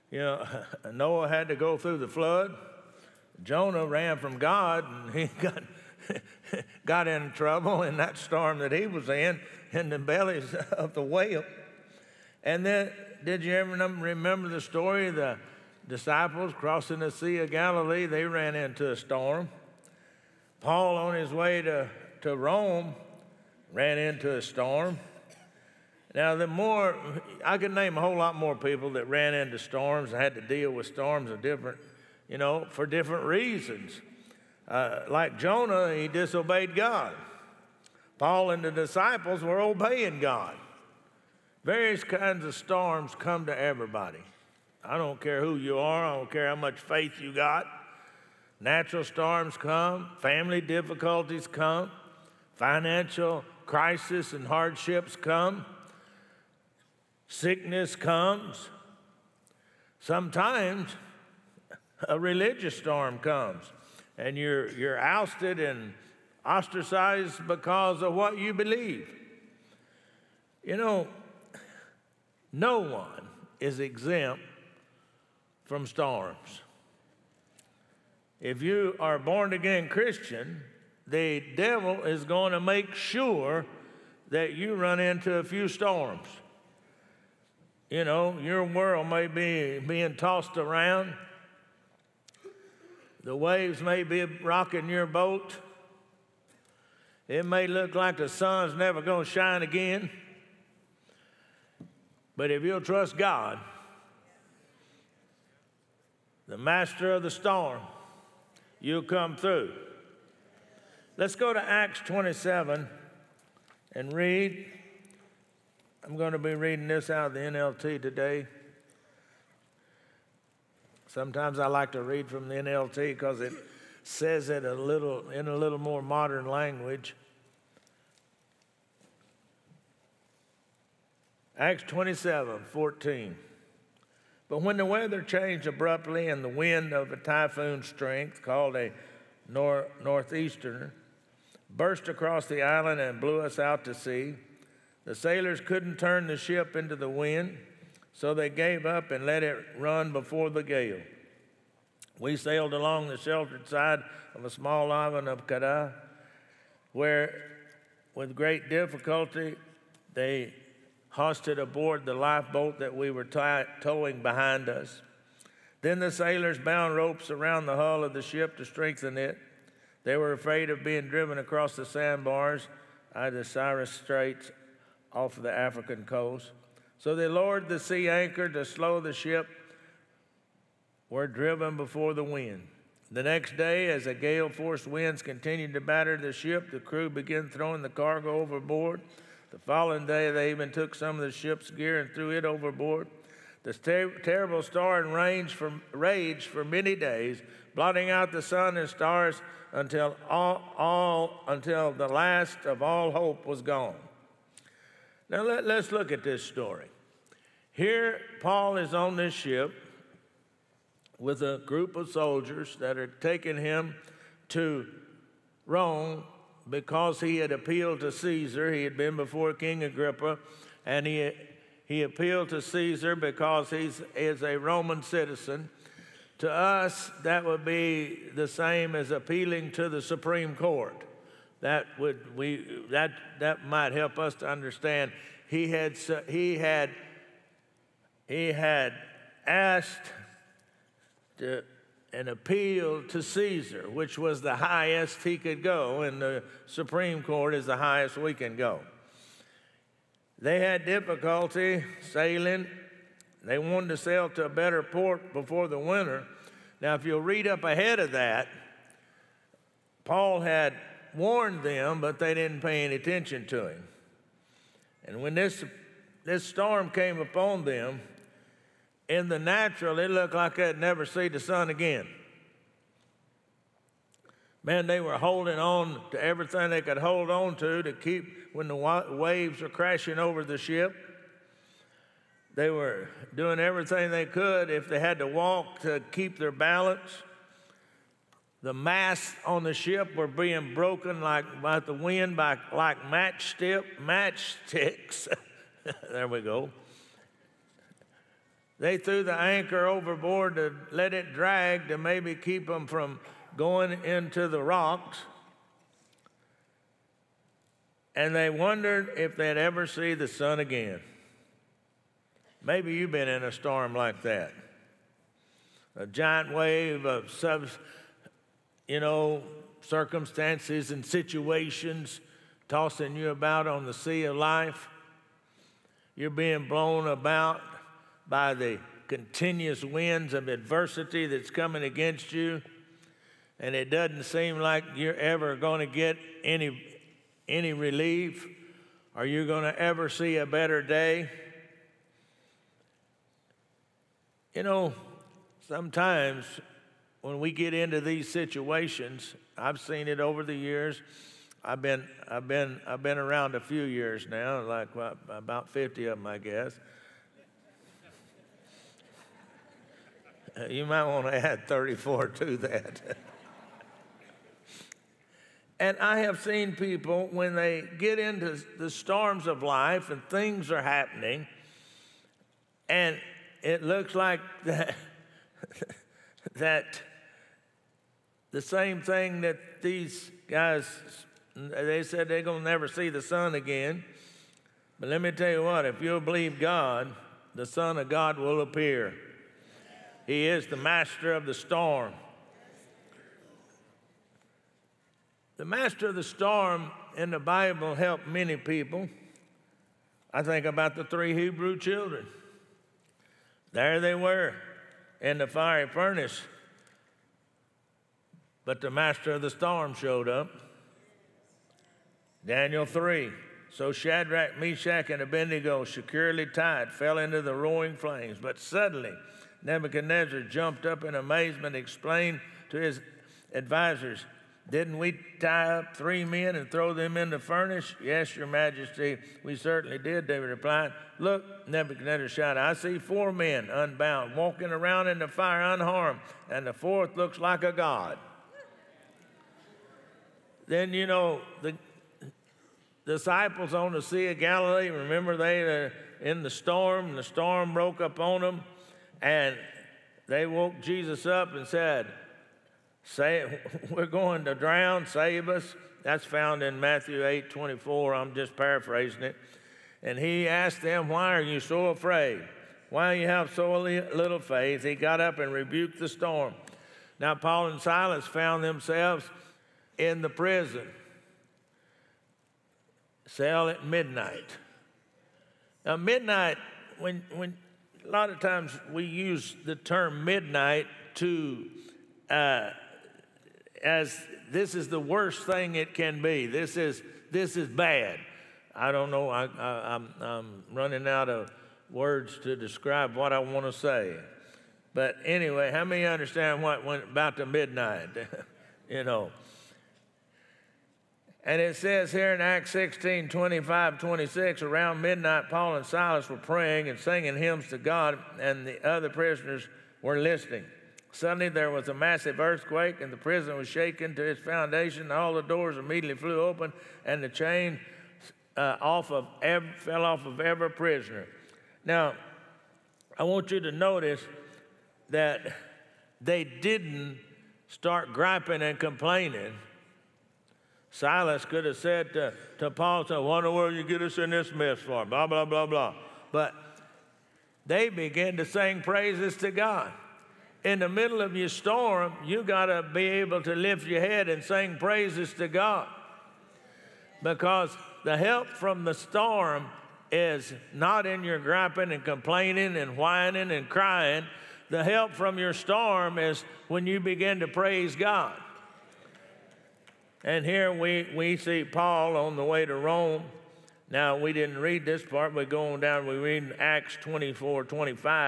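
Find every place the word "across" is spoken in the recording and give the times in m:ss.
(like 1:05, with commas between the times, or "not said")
2:22, 2:51.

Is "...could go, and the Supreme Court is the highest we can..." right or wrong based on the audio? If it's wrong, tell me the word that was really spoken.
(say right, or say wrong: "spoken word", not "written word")
right.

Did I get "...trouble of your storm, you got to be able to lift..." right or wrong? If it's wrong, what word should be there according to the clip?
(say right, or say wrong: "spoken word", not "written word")
wrong: "middle", not "trouble".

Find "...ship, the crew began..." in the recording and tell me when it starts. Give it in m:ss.
3:06.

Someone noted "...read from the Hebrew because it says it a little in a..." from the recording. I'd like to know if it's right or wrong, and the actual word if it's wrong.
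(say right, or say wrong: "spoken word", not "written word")
wrong: "NLT", not "Hebrew".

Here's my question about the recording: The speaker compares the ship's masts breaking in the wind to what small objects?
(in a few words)
Matchsticks.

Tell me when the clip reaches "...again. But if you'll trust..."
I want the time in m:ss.
1:39.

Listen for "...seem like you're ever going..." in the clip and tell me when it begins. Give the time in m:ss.
5:34.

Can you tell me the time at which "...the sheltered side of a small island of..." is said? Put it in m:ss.
2:33.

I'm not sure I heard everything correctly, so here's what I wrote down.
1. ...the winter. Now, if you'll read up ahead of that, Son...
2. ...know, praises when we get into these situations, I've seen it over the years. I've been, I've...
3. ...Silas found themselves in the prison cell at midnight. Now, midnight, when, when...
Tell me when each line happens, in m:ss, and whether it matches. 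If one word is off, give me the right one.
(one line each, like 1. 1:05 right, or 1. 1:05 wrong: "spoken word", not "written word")
1. 4:15 wrong: "Paul", not "Son"
2. 5:44 wrong: "sometimes", not "praises"
3. 7:47 right.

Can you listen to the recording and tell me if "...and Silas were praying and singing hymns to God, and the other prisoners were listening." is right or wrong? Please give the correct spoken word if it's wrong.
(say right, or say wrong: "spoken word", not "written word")
right.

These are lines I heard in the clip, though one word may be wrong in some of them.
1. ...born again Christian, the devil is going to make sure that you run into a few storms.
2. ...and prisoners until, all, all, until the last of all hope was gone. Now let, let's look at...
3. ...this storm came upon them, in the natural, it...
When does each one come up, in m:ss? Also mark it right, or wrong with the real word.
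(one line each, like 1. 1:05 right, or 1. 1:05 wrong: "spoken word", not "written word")
1. 1:19 right
2. 3:18 wrong: "stars", not "prisoners"
3. 4:26 right.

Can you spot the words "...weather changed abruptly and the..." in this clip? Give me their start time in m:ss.
2:14.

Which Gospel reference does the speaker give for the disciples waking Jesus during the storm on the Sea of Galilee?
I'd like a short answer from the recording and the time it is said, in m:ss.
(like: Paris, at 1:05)
Matthew 8:24, at 7:36.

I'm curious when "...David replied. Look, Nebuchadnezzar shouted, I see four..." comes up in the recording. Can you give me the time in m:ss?
7:10.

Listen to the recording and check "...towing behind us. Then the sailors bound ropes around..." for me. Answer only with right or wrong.
right.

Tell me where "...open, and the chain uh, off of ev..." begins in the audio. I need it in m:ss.
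8:36.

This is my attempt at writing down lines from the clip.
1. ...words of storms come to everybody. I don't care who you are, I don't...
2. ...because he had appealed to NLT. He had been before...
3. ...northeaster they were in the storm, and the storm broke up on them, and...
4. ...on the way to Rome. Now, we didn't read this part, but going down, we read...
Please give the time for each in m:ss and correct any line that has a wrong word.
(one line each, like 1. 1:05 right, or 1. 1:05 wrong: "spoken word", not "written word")
1. 0:42 wrong: "kinds", not "words"
2. 3:36 wrong: "Caesar", not "NLT"
3. 7:24 wrong: "remember", not "northeaster"
4. 9:22 right.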